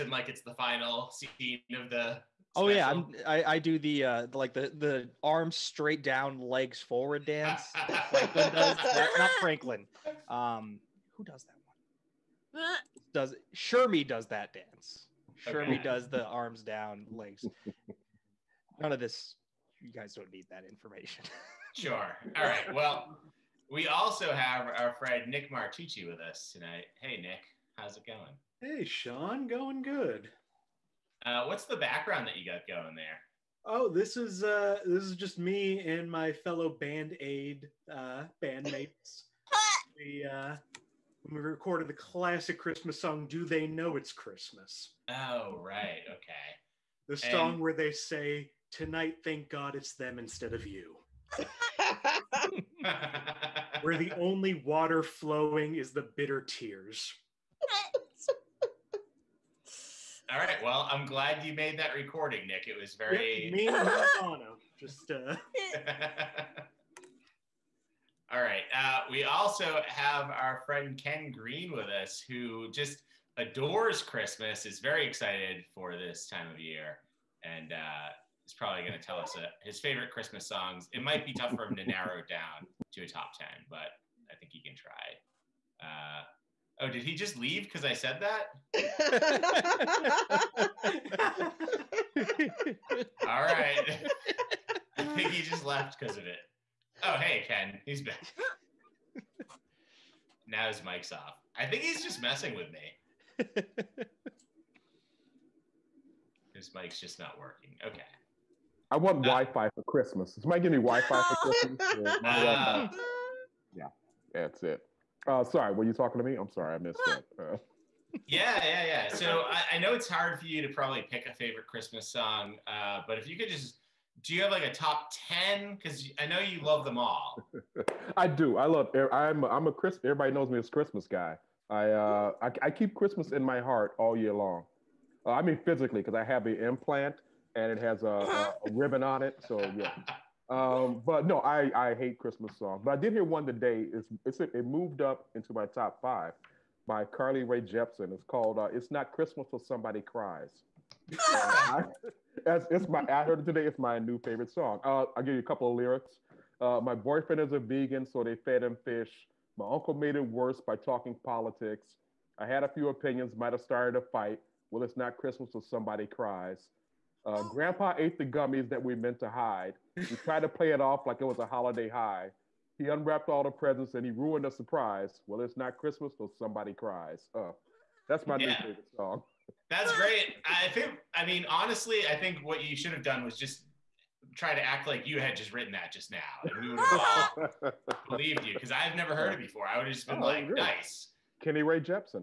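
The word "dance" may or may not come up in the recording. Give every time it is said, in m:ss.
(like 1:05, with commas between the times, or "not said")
0:07, 0:14.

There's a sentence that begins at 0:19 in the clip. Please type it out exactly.
You guys don't need that information.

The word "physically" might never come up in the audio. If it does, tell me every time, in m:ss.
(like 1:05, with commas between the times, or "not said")
2:15.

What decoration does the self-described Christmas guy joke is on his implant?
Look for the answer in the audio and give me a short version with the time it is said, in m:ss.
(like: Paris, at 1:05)
A ribbon, at 2:18.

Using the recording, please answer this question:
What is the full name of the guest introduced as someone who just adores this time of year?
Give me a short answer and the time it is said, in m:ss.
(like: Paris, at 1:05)
Ken Green, at 1:11.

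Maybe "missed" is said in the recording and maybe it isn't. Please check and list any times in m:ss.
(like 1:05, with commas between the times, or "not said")
1:56.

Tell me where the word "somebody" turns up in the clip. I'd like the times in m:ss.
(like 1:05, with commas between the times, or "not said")
1:50, 2:29, 2:45, 2:56.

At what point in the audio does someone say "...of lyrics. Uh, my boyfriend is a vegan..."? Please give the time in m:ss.
2:35.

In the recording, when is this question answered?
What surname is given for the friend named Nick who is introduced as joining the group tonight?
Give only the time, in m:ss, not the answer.
0:25.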